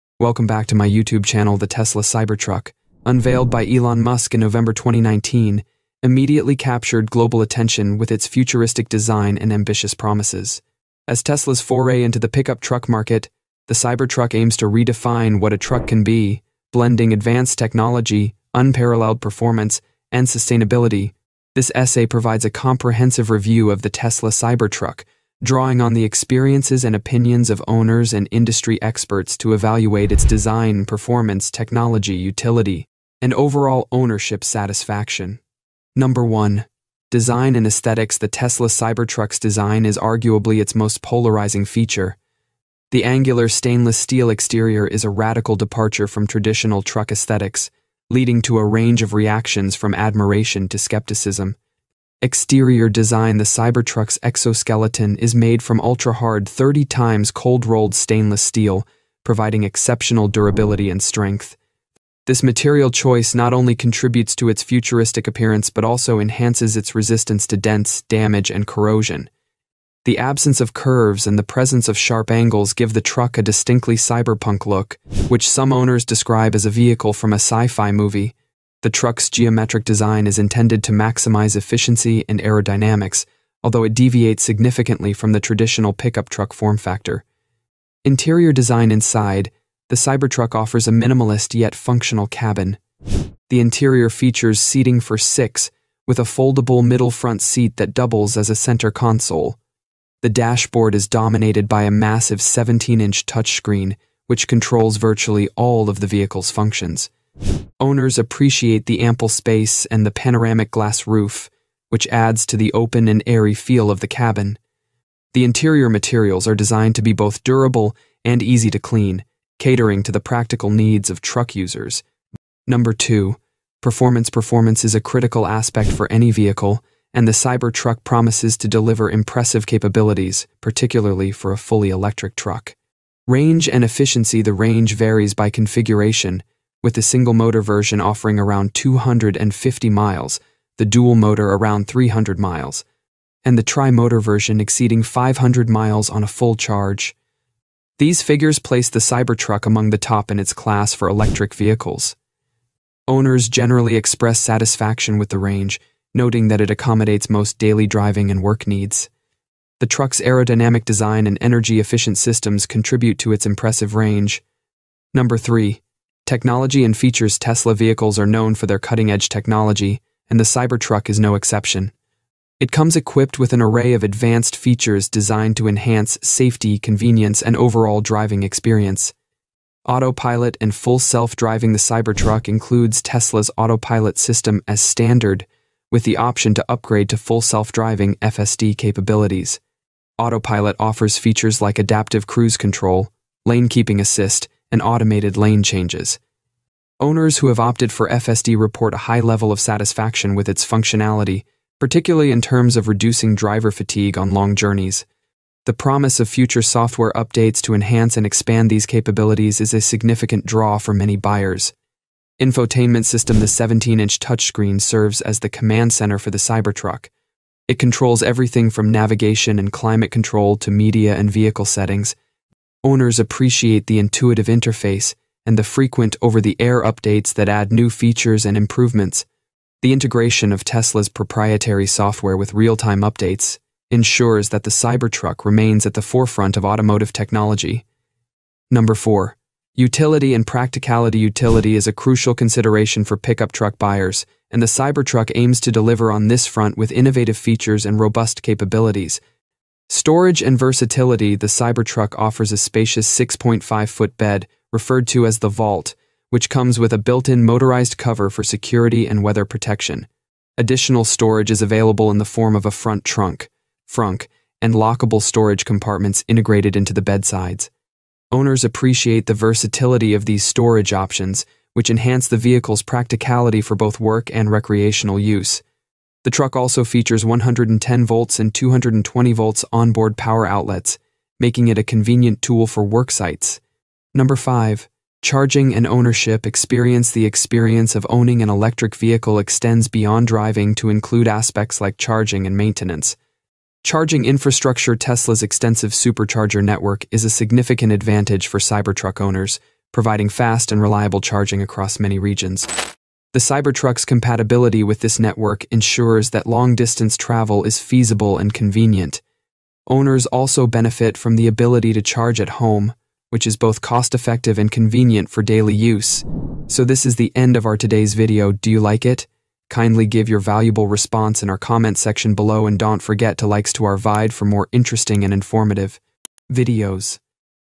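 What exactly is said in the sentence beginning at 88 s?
Interior design inside, the Cybertruck offers a minimalist yet functional cabin.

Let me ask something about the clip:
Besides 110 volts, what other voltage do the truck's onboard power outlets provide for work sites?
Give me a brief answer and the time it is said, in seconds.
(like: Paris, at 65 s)
220 volts, at 278 s.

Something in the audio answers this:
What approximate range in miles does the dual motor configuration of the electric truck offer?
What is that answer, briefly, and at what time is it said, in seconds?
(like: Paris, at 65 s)
300 miles, at 141 s.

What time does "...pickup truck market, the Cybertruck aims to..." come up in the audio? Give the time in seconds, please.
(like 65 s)
12 s.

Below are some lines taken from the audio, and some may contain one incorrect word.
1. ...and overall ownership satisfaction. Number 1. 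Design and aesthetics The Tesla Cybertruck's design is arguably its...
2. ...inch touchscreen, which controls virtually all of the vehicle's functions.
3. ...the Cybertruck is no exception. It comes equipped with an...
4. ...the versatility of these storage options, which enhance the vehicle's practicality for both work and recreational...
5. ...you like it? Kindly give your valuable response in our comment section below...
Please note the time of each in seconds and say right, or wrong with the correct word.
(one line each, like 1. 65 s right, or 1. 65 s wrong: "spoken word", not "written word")
1. 33 s right
2. 102 s right
3. 170 s right
4. 269 s right
5. 318 s right.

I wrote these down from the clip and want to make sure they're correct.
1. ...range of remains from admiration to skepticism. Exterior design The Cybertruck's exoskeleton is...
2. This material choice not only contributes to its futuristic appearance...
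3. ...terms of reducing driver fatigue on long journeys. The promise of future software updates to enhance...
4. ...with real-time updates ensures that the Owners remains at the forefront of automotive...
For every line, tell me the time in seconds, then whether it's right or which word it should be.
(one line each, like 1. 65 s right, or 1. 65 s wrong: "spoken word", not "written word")
1. 48 s wrong: "reactions", not "remains"
2. 62 s right
3. 202 s right
4. 232 s wrong: "Cybertruck", not "Owners".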